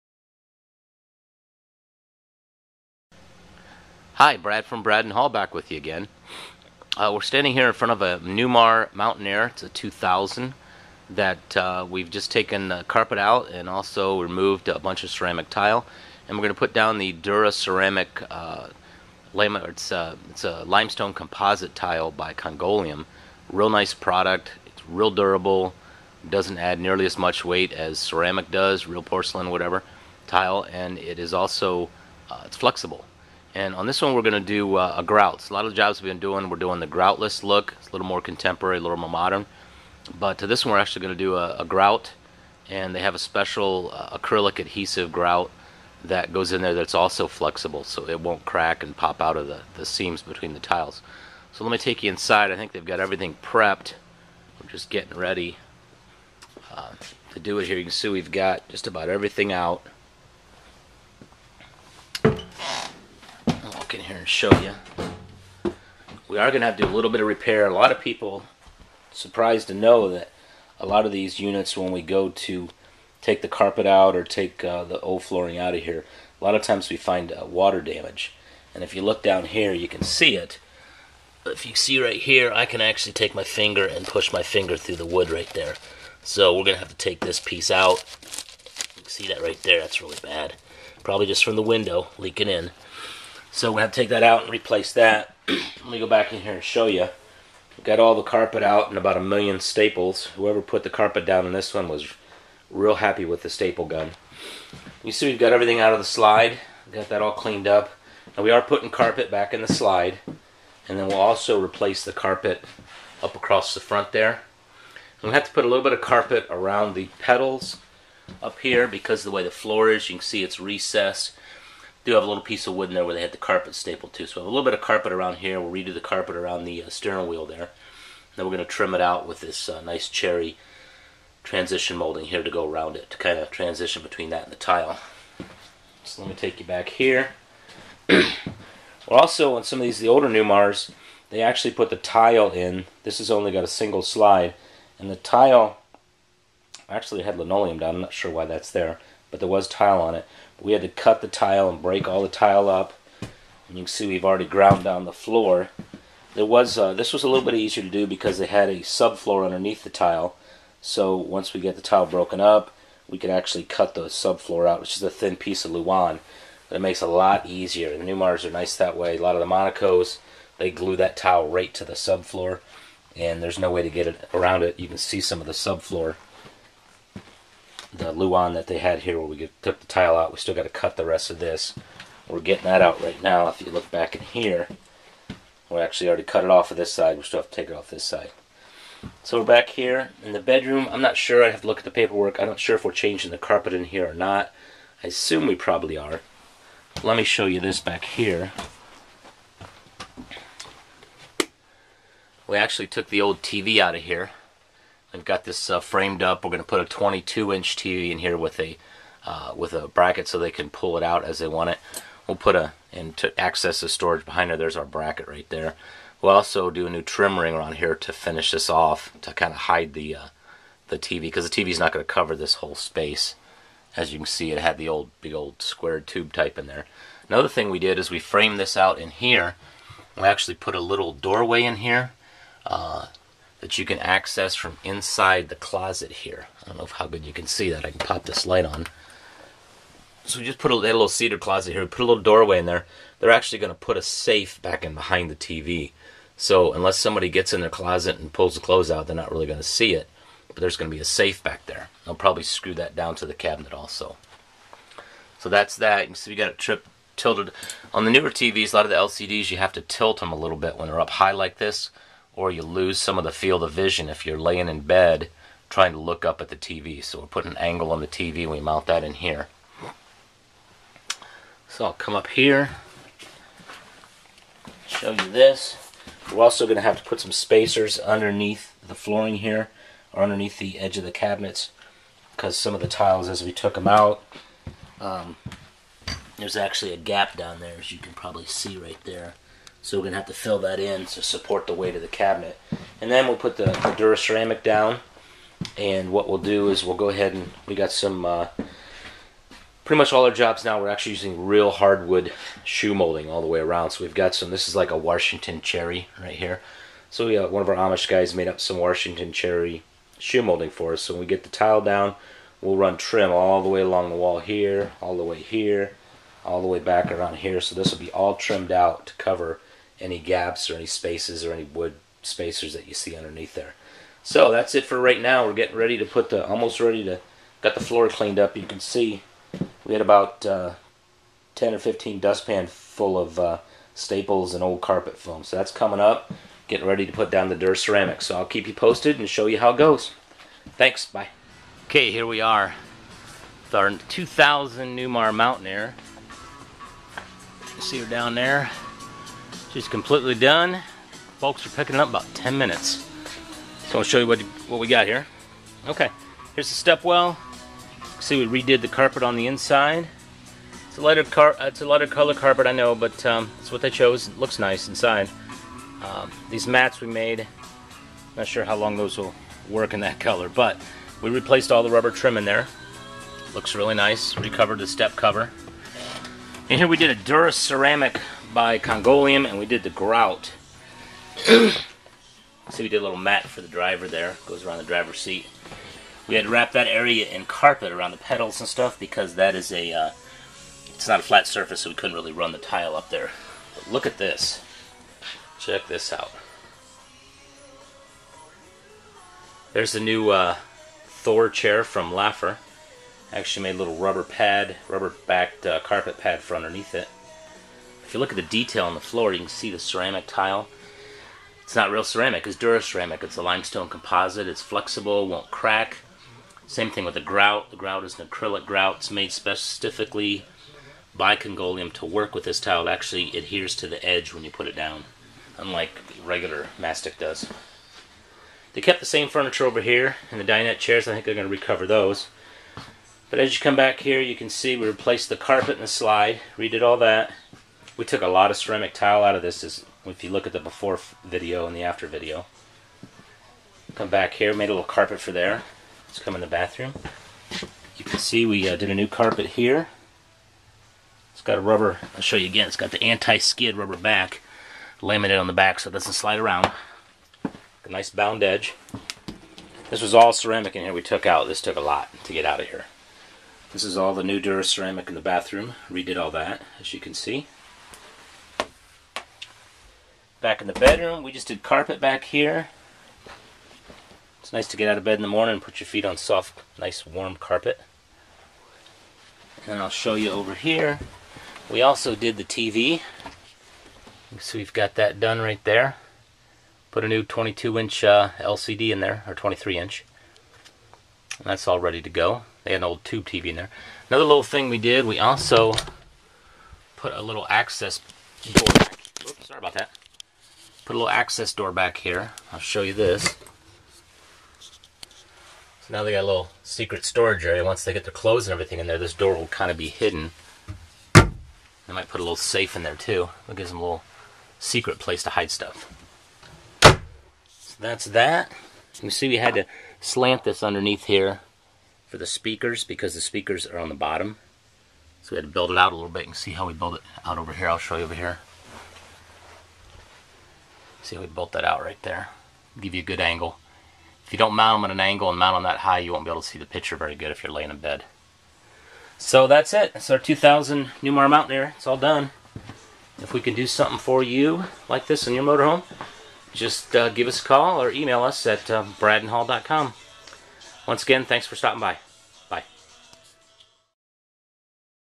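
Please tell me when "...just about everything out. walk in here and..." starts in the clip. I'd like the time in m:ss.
0:58.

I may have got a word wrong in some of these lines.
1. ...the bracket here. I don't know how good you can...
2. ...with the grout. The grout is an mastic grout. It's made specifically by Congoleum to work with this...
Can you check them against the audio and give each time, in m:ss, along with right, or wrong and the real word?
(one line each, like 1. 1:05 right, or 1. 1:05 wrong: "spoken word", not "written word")
1. 3:55 wrong: "closet", not "bracket"
2. 6:57 wrong: "acrylic", not "mastic".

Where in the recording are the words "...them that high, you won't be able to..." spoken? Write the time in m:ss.
8:55.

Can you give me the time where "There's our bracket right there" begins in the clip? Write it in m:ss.
3:34.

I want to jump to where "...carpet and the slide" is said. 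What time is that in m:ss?
7:15.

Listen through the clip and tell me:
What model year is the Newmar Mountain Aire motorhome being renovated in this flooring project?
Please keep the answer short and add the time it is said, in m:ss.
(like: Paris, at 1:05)
2000, at 0:09.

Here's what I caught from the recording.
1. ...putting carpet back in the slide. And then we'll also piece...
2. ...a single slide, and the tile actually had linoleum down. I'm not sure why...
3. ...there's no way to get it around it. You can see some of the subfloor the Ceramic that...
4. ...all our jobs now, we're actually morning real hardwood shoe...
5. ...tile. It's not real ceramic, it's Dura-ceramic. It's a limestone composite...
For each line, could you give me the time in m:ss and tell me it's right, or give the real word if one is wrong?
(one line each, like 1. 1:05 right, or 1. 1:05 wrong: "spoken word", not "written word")
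1. 1:48 wrong: "replace", not "piece"
2. 2:23 right
3. 2:53 wrong: "Luan", not "Ceramic"
4. 5:00 wrong: "using", not "morning"
5. 6:50 right.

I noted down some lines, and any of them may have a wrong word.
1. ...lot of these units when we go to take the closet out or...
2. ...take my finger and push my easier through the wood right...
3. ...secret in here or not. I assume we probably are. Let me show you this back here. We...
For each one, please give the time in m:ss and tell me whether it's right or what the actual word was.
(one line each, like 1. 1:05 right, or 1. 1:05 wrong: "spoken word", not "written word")
1. 1:10 wrong: "carpet", not "closet"
2. 1:23 wrong: "finger", not "easier"
3. 3:13 wrong: "carpet", not "secret".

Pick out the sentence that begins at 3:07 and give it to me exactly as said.
We still have to take it off this side.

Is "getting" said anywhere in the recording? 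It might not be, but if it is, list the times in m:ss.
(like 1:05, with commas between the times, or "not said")
0:54, 3:02, 5:25, 5:36.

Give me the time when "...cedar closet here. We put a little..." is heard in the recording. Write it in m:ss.
4:01.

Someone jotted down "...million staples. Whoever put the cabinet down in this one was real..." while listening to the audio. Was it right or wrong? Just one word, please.
wrong.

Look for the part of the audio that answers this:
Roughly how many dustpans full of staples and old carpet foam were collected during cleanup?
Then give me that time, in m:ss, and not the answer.
5:31.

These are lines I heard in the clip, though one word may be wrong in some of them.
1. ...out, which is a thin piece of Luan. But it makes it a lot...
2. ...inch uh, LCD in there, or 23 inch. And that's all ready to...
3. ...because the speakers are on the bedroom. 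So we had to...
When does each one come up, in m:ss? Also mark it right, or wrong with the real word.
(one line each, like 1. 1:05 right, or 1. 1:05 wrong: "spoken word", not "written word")
1. 2:44 right
2. 8:07 right
3. 8:42 wrong: "bottom", not "bedroom".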